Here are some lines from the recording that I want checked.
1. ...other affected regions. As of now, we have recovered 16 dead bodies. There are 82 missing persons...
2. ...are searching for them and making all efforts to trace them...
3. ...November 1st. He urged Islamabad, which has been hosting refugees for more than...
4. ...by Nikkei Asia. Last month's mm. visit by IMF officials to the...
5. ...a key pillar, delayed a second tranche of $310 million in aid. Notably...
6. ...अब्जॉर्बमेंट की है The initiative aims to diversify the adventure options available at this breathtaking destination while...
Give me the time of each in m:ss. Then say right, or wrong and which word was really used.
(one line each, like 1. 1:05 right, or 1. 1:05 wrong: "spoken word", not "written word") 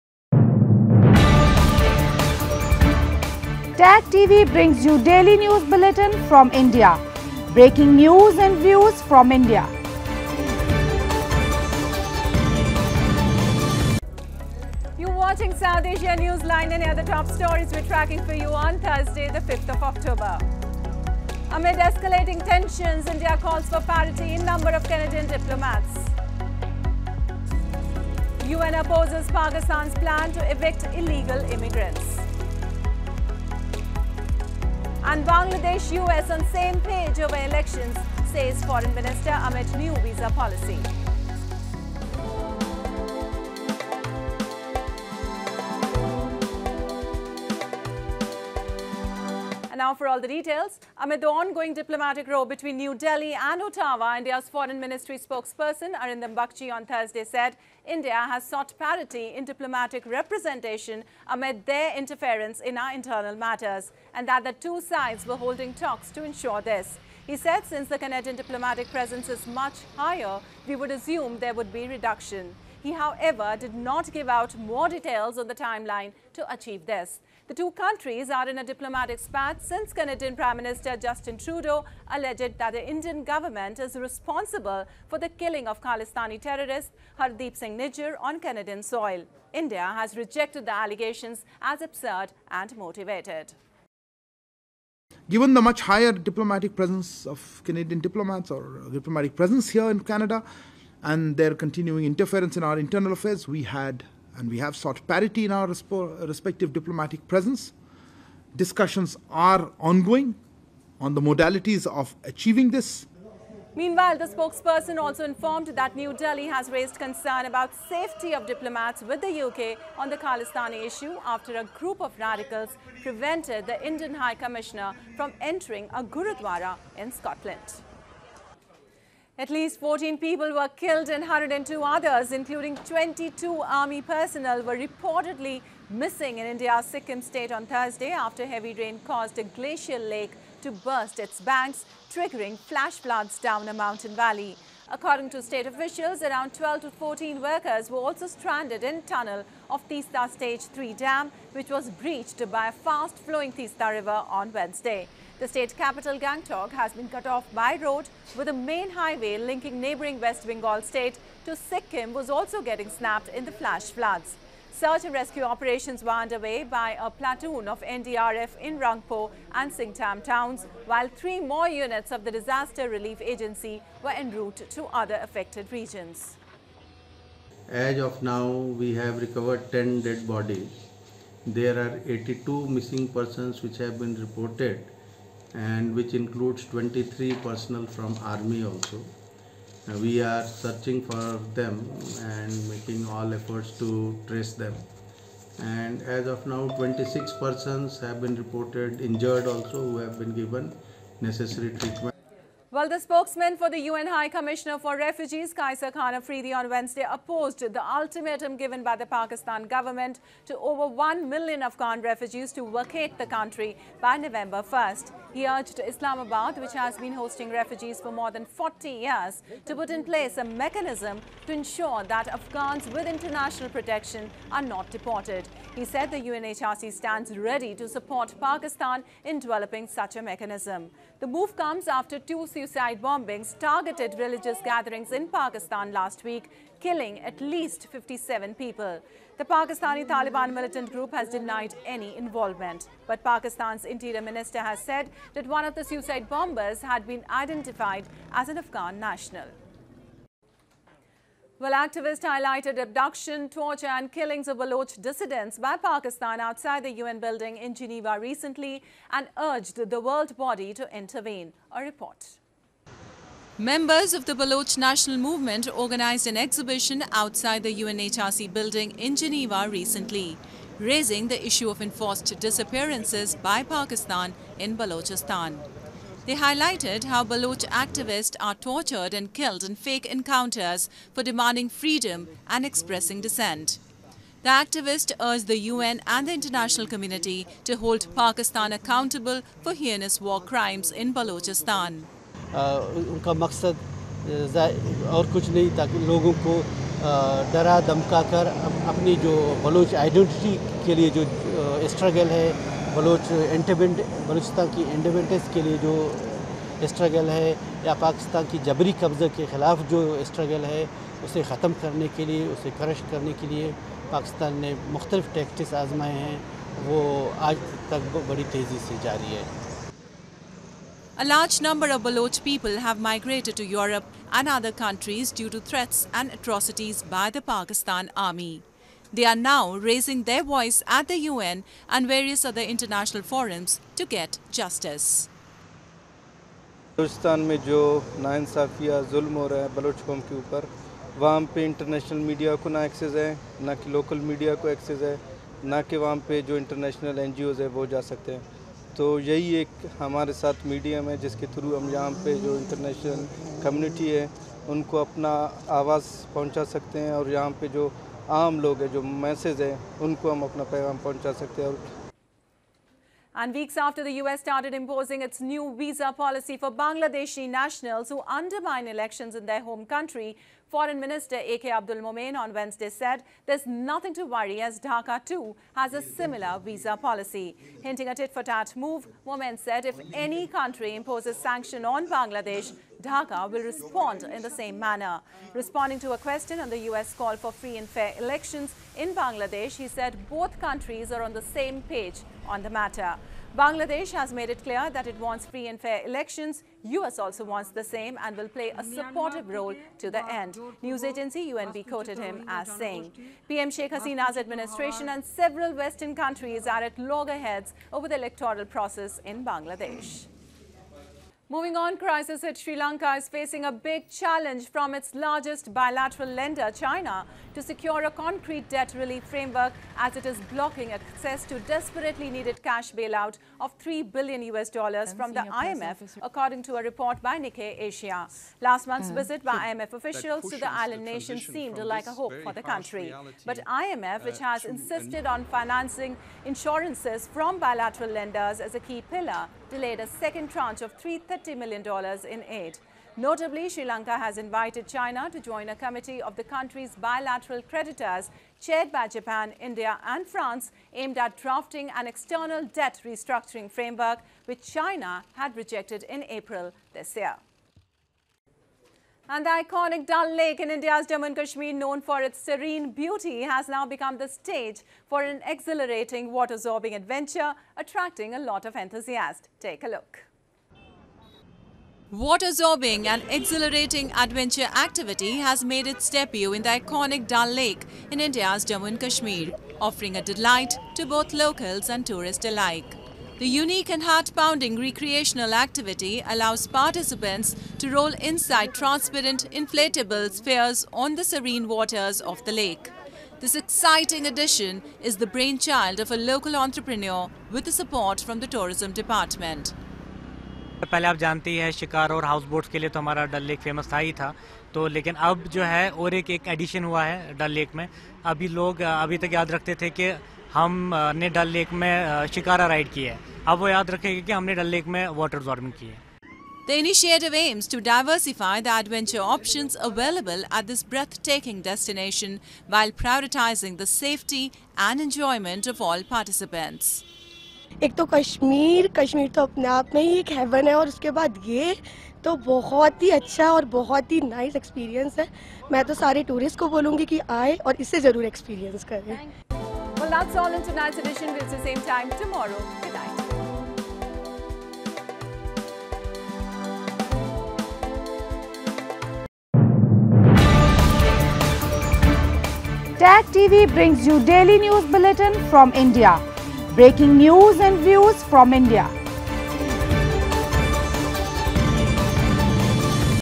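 1. 2:55 wrong: "10", not "16"
2. 3:10 right
3. 3:34 right
4. 7:07 right
5. 7:18 wrong: "330", not "310"
6. 8:35 right.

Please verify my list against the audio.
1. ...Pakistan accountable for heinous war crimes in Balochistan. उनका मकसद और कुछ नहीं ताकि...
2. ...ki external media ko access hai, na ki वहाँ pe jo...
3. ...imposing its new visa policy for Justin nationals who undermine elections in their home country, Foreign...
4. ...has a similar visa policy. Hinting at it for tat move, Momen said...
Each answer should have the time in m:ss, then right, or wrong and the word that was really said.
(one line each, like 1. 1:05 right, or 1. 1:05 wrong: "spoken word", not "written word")
1. 4:48 right
2. 5:43 wrong: "local", not "external"
3. 6:04 wrong: "Bangladeshi", not "Justin"
4. 6:15 right.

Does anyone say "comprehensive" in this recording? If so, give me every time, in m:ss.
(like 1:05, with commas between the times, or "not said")
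not said.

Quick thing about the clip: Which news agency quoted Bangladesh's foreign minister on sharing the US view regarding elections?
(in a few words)
UNB.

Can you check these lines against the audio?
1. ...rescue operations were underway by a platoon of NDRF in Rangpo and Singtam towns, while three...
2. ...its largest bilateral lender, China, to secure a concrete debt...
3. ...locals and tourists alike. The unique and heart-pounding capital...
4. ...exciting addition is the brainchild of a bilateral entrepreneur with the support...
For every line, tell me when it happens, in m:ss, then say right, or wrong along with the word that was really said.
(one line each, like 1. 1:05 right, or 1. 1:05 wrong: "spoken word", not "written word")
1. 2:45 right
2. 6:54 right
3. 8:01 wrong: "recreational", not "capital"
4. 8:13 wrong: "local", not "bilateral".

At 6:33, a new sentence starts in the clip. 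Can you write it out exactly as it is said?
Bangladesh has made it clear that it wants free and fair elections.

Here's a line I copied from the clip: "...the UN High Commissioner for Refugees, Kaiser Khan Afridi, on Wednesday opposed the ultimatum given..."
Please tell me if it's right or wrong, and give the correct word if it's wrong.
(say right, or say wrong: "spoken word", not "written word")
right.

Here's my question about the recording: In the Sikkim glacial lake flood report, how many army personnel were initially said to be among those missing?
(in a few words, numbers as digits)
22.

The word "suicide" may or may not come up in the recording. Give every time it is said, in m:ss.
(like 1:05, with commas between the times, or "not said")
3:52, 4:05.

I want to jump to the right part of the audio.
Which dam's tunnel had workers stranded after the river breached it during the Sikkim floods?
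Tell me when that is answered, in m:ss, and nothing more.
2:29.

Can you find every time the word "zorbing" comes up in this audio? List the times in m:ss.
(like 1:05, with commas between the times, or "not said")
7:46, 7:52.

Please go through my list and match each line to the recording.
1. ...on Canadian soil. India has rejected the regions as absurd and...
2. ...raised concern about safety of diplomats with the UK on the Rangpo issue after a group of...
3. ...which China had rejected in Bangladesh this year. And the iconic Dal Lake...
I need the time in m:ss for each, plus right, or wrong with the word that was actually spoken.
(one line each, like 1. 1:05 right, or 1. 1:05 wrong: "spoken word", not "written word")
1. 1:28 wrong: "allegations", not "regions"
2. 1:56 wrong: "Khalistani", not "Rangpo"
3. 7:34 wrong: "April", not "Bangladesh".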